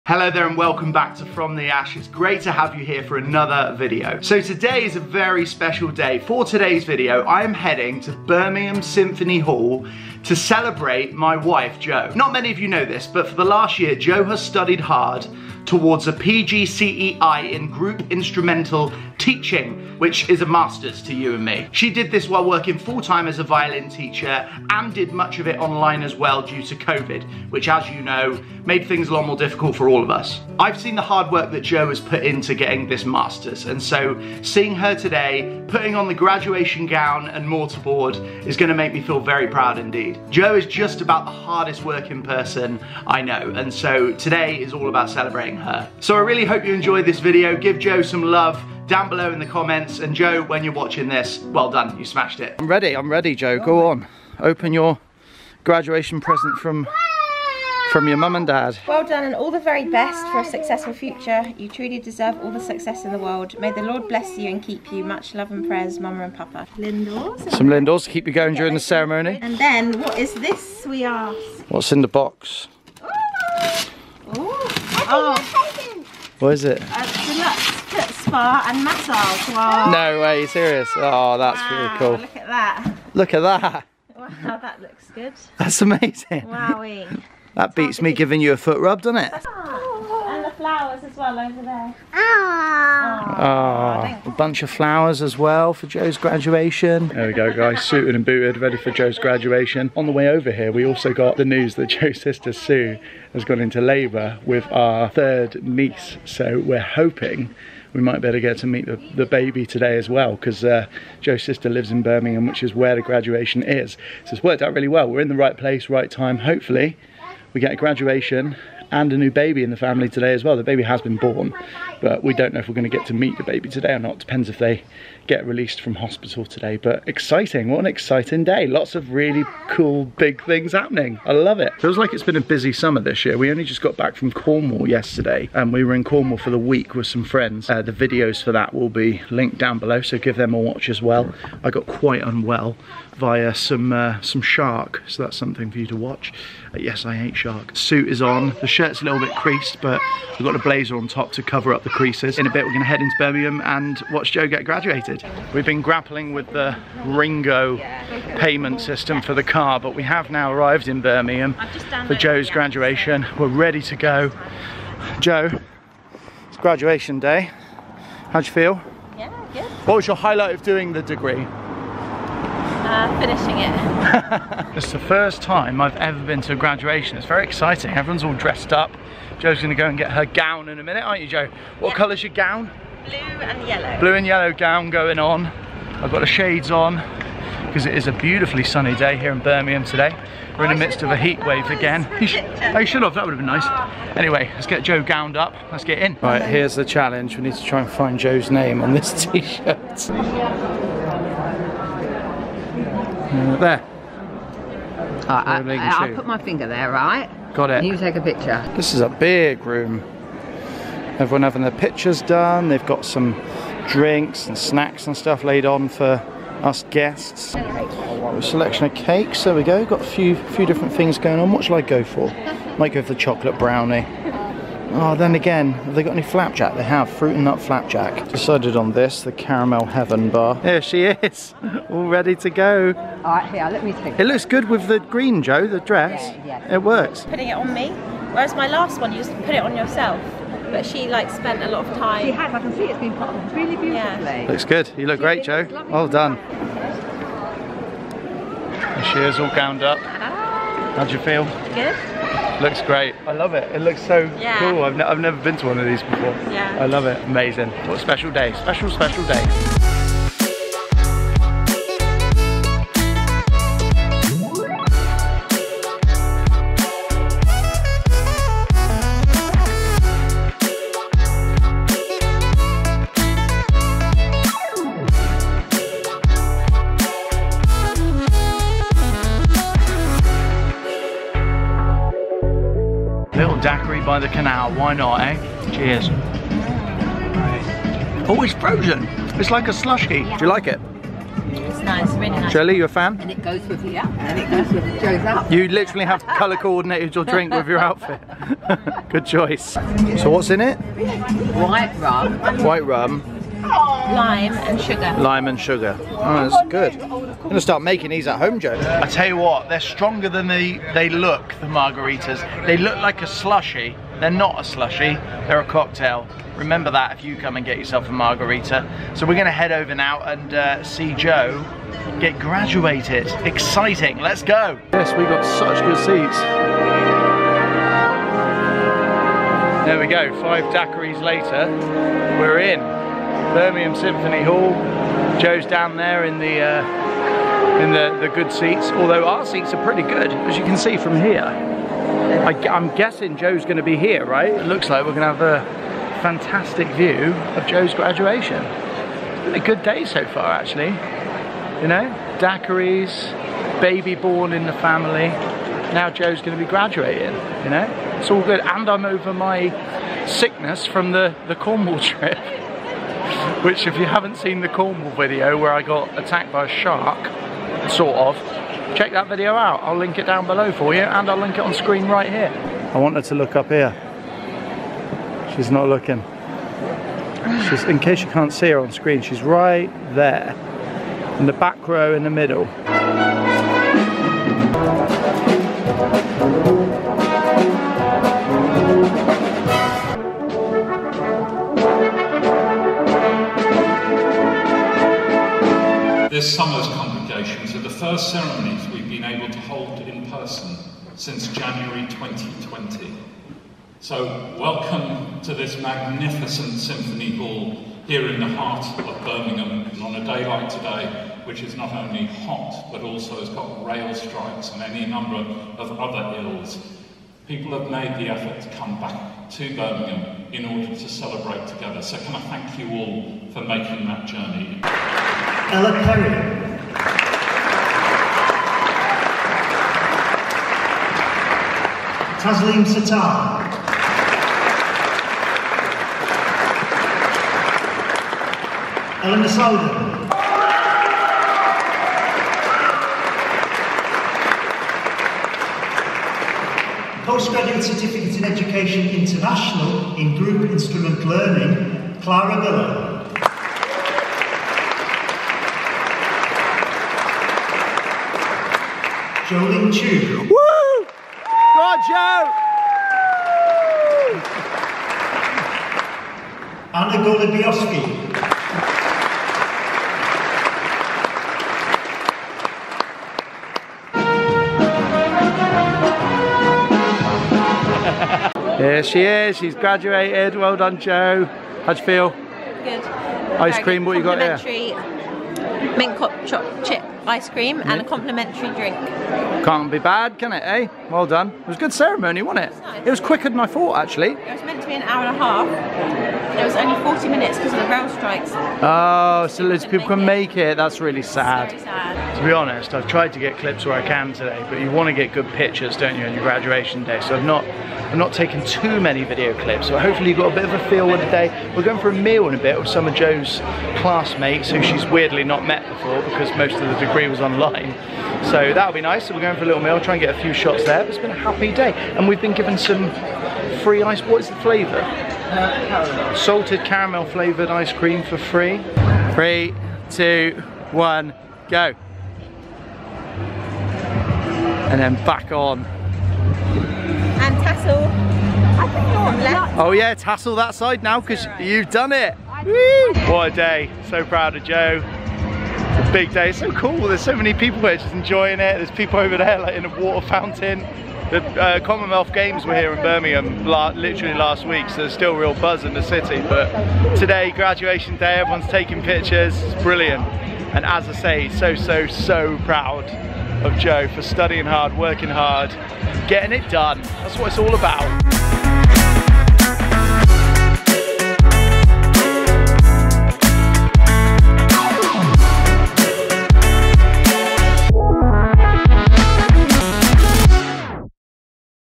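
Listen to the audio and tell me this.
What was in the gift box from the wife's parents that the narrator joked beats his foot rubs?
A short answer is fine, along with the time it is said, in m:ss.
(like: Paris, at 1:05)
Foot spa and massage, at 1:16.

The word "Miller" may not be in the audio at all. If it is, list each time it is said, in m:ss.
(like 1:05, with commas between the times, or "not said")
7:32.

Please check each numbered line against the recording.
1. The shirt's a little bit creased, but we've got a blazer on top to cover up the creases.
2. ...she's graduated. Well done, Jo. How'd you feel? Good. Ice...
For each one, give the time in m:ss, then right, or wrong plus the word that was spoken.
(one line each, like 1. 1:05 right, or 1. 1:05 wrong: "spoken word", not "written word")
1. 2:28 right
2. 7:59 right.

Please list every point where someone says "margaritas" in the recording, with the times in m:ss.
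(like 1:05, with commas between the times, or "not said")
5:11, 5:18.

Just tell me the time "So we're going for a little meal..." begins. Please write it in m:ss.
8:39.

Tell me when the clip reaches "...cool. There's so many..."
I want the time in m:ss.
9:06.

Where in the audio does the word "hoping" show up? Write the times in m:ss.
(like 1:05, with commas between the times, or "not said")
1:46.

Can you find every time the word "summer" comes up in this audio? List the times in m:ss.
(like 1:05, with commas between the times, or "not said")
2:12, 6:36.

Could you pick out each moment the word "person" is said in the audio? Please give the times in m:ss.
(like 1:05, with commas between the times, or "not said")
0:42, 6:40.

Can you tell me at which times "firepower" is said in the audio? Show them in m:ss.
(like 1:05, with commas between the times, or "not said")
not said.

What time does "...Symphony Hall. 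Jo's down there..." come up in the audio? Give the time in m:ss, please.
5:33.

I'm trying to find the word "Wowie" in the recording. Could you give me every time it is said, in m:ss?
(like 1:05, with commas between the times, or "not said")
1:26.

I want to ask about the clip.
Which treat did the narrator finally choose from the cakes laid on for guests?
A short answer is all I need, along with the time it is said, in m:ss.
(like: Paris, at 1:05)
Caramel heaven bar, at 3:49.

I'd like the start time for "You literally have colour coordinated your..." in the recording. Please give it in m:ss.
4:55.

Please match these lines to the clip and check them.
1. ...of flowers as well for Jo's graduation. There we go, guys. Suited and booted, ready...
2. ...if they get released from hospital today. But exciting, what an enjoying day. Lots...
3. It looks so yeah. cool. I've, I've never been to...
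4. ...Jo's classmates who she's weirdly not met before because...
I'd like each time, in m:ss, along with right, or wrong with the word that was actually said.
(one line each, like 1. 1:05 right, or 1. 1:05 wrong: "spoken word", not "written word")
1. 1:34 right
2. 2:04 wrong: "exciting", not "enjoying"
3. 4:13 right
4. 8:33 right.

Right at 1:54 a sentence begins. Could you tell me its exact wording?
So it's worked out really well.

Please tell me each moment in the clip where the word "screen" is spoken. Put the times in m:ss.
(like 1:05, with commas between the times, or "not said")
6:11, 6:18.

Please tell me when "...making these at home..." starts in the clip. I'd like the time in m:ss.
5:07.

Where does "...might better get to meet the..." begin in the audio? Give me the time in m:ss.
1:48.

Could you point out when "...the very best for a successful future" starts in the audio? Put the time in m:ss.
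0:59.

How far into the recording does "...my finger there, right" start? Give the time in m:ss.
3:26.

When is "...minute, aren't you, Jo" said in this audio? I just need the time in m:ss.
3:00.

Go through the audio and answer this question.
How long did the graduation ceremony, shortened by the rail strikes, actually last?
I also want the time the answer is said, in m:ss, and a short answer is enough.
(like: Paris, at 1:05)
40 minutes, at 8:17.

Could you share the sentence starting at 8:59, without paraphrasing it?
Oh yeah, tassel that side now because right.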